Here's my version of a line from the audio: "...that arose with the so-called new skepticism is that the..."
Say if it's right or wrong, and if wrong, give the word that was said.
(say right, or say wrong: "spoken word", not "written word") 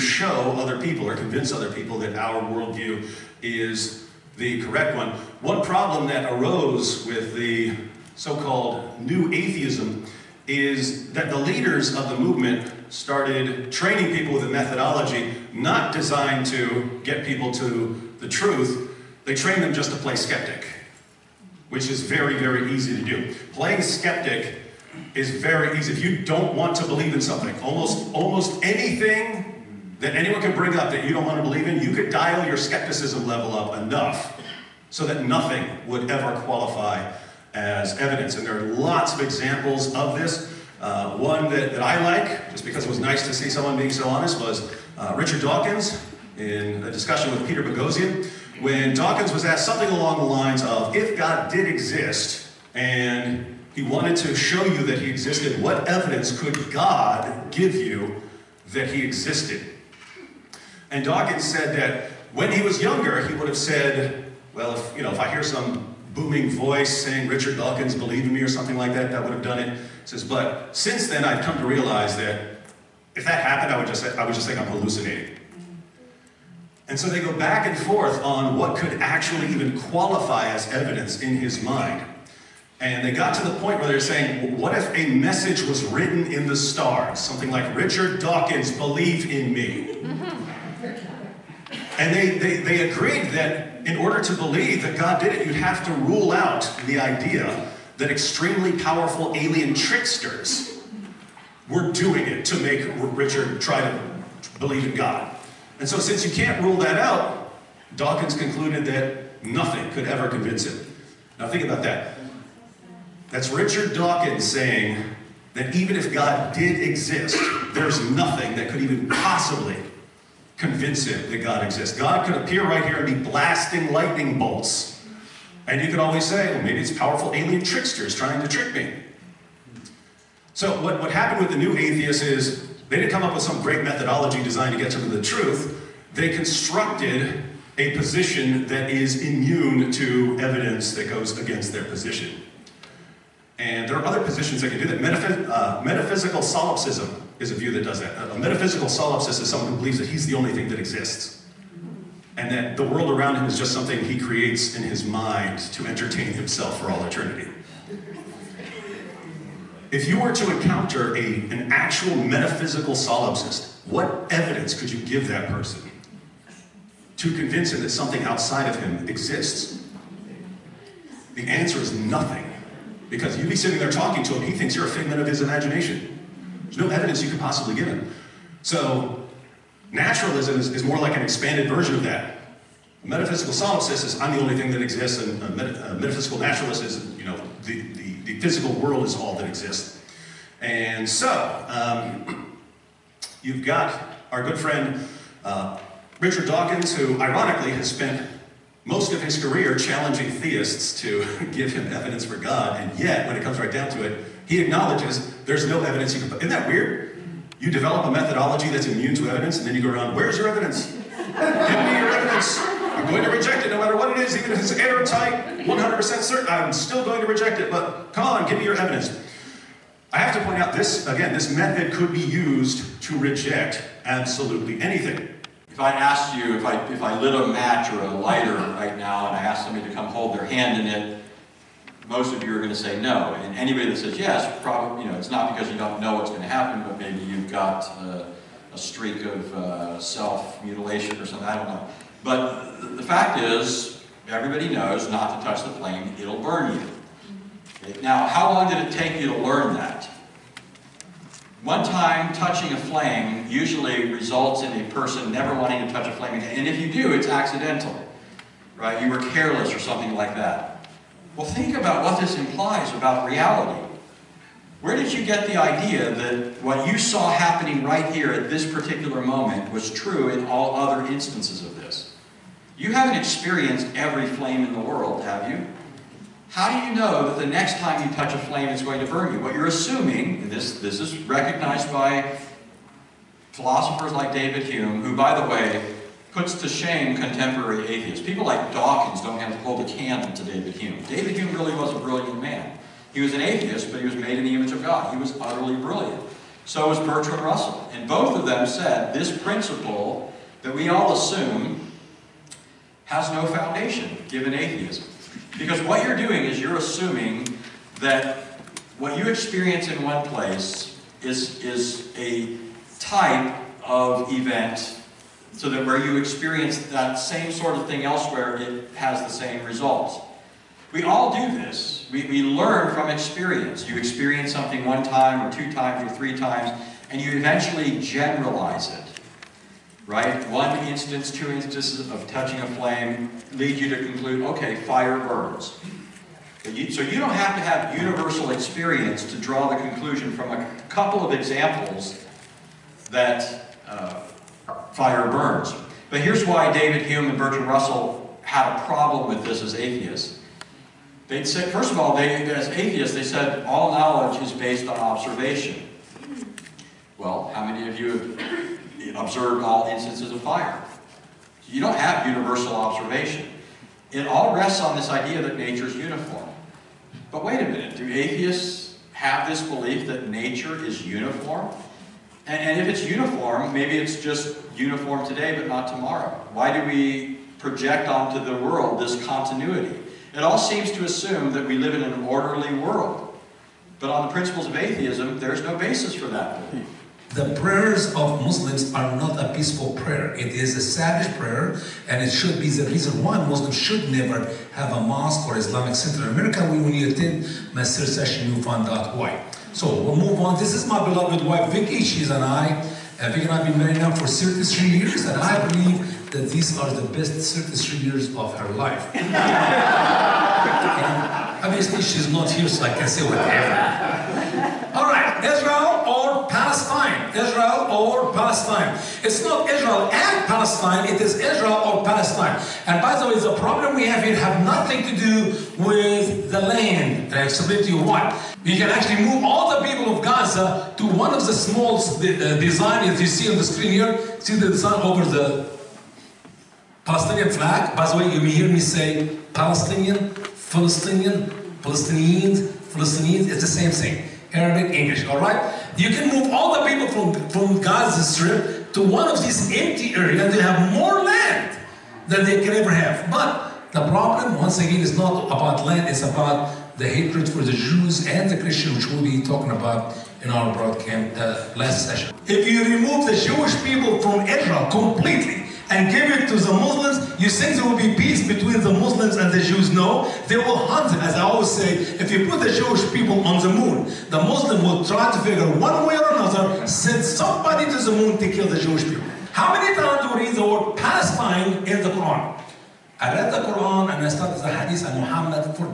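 wrong: "atheism", not "skepticism".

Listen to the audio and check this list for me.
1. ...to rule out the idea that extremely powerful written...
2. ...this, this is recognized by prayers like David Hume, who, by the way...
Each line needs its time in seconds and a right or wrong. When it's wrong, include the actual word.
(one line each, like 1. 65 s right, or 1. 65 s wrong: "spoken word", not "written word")
1. 95 s wrong: "alien", not "written"
2. 280 s wrong: "philosophers", not "prayers".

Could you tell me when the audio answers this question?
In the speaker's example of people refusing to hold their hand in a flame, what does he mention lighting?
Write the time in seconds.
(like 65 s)
227 s.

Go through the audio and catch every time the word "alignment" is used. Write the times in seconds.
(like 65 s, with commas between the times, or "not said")
not said.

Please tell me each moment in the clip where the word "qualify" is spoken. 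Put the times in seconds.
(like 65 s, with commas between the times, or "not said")
36 s, 79 s.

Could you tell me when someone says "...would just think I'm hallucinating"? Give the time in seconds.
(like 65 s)
74 s.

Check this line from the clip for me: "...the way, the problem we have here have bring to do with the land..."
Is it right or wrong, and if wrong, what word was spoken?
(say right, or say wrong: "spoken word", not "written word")
wrong: "nothing", not "bring".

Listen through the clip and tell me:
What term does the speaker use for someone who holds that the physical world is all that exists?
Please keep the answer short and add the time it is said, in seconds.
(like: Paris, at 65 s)
metaphysical naturalist, at 185 s.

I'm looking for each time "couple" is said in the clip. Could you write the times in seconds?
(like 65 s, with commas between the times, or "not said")
340 s.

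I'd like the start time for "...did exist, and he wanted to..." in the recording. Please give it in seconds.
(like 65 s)
51 s.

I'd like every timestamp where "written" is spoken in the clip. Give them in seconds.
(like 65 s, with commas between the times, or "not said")
85 s.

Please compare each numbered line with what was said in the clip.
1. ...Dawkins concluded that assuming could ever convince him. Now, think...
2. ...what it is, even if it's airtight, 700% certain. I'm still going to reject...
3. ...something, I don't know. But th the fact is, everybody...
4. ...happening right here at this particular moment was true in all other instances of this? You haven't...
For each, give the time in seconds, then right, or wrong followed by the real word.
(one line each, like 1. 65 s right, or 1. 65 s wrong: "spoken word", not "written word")
1. 107 s wrong: "nothing", not "assuming"
2. 213 s wrong: "100", not "700"
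3. 241 s right
4. 267 s right.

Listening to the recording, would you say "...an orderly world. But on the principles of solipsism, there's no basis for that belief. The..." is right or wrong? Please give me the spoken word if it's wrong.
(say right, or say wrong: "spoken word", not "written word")
wrong: "atheism", not "solipsism".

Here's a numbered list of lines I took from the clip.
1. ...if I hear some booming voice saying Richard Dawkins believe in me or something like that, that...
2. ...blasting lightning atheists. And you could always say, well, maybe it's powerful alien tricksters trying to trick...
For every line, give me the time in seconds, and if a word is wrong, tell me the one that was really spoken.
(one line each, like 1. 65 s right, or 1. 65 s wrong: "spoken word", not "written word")
1. 65 s right
2. 123 s wrong: "bolts", not "atheists".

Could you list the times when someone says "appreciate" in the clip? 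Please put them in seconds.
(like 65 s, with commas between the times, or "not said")
not said.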